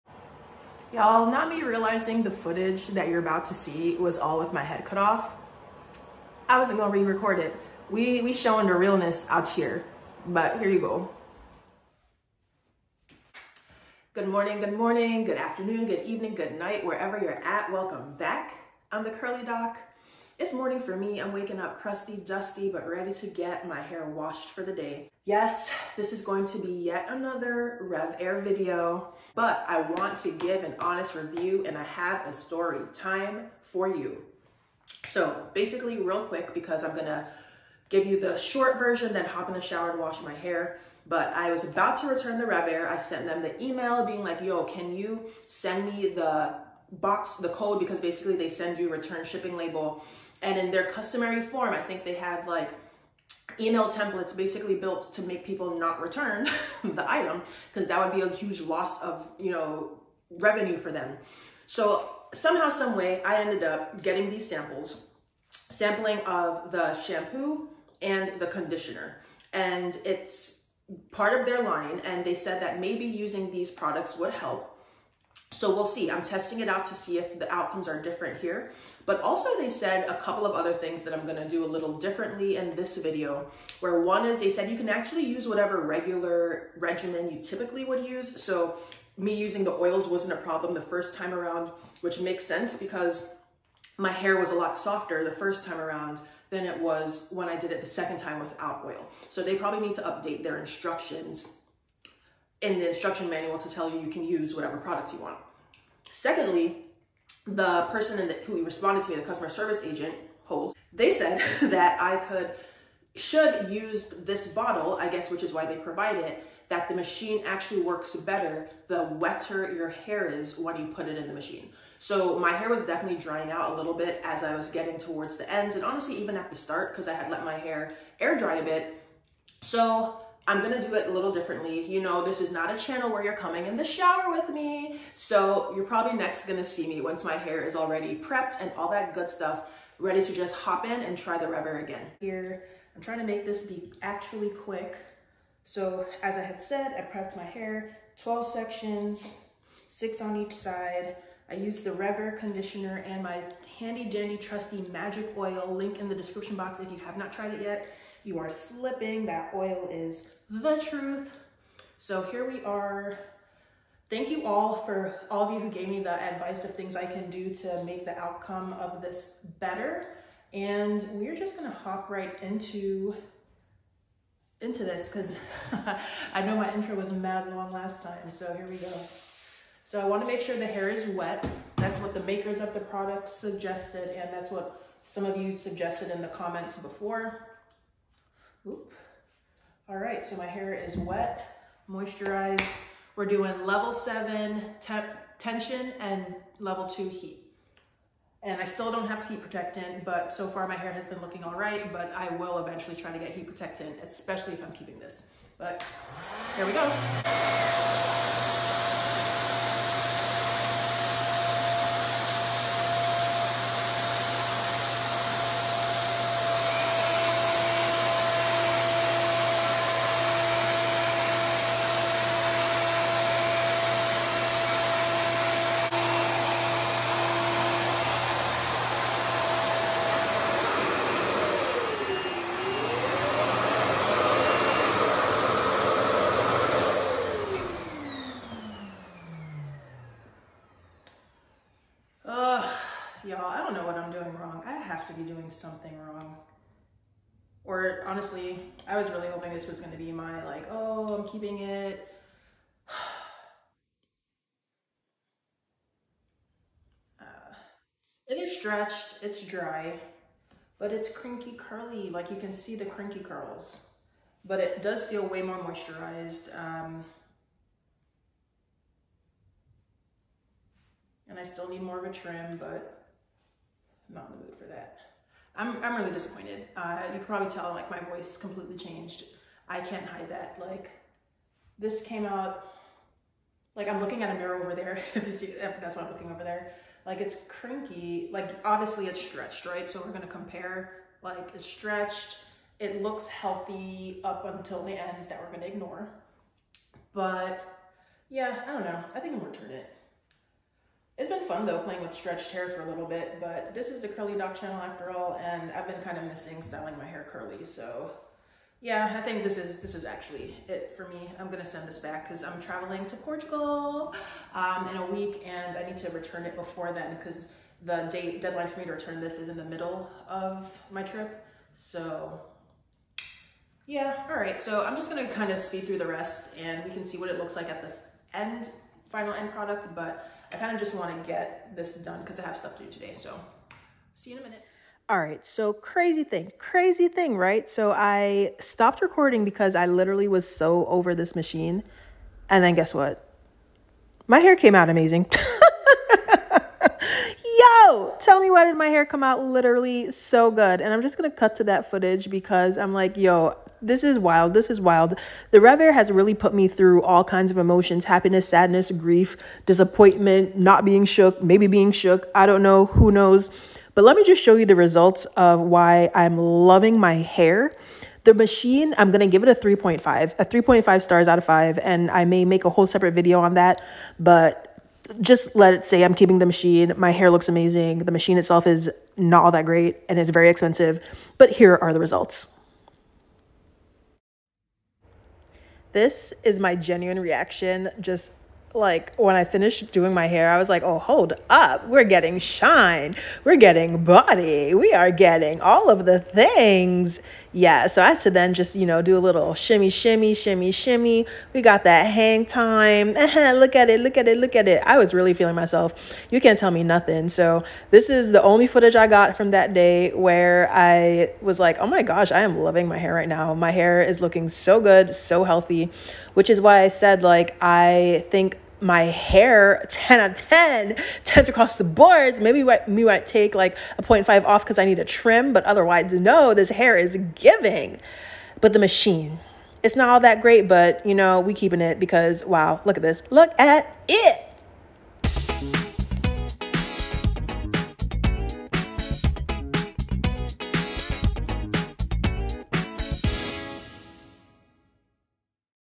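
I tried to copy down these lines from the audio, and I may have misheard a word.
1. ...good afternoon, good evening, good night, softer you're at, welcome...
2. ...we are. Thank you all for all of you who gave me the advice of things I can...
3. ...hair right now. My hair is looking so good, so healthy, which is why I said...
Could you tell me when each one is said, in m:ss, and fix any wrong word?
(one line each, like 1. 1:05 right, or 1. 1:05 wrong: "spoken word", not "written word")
1. 0:15 wrong: "wherever", not "softer"
2. 2:42 right
3. 6:52 right.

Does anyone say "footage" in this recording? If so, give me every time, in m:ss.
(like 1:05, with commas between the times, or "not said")
0:02, 5:51, 6:48.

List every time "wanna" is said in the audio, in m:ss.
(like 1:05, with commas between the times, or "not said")
3:00.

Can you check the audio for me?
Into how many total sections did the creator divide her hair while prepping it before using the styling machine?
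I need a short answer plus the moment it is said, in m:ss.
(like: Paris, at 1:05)
12, at 2:28.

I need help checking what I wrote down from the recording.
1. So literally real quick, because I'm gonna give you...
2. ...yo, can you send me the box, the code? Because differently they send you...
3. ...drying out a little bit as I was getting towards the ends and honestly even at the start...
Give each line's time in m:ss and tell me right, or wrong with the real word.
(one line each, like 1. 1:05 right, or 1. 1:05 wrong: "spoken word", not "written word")
1. 0:35 wrong: "basically", not "literally"
2. 0:44 wrong: "basically", not "differently"
3. 2:03 right.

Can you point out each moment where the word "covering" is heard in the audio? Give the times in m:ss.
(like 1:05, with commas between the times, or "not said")
not said.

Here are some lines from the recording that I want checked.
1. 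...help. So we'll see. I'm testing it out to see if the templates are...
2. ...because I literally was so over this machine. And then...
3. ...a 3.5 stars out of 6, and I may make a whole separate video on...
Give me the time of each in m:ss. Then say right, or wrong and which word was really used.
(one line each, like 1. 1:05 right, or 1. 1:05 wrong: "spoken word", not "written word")
1. 1:14 wrong: "outcomes", not "templates"
2. 5:39 right
3. 6:10 wrong: "5", not "6".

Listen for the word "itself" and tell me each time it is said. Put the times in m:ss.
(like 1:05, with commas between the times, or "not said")
6:18.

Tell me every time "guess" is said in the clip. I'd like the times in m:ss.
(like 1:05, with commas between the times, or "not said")
1:55, 5:42.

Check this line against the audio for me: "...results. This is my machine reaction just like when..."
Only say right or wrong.
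wrong.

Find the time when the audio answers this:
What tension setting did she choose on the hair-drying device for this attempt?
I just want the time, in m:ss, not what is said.
3:13.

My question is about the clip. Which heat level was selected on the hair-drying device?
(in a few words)
level 2.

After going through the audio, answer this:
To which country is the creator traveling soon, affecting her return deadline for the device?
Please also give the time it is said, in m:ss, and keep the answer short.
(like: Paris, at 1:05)
Portugal, at 5:13.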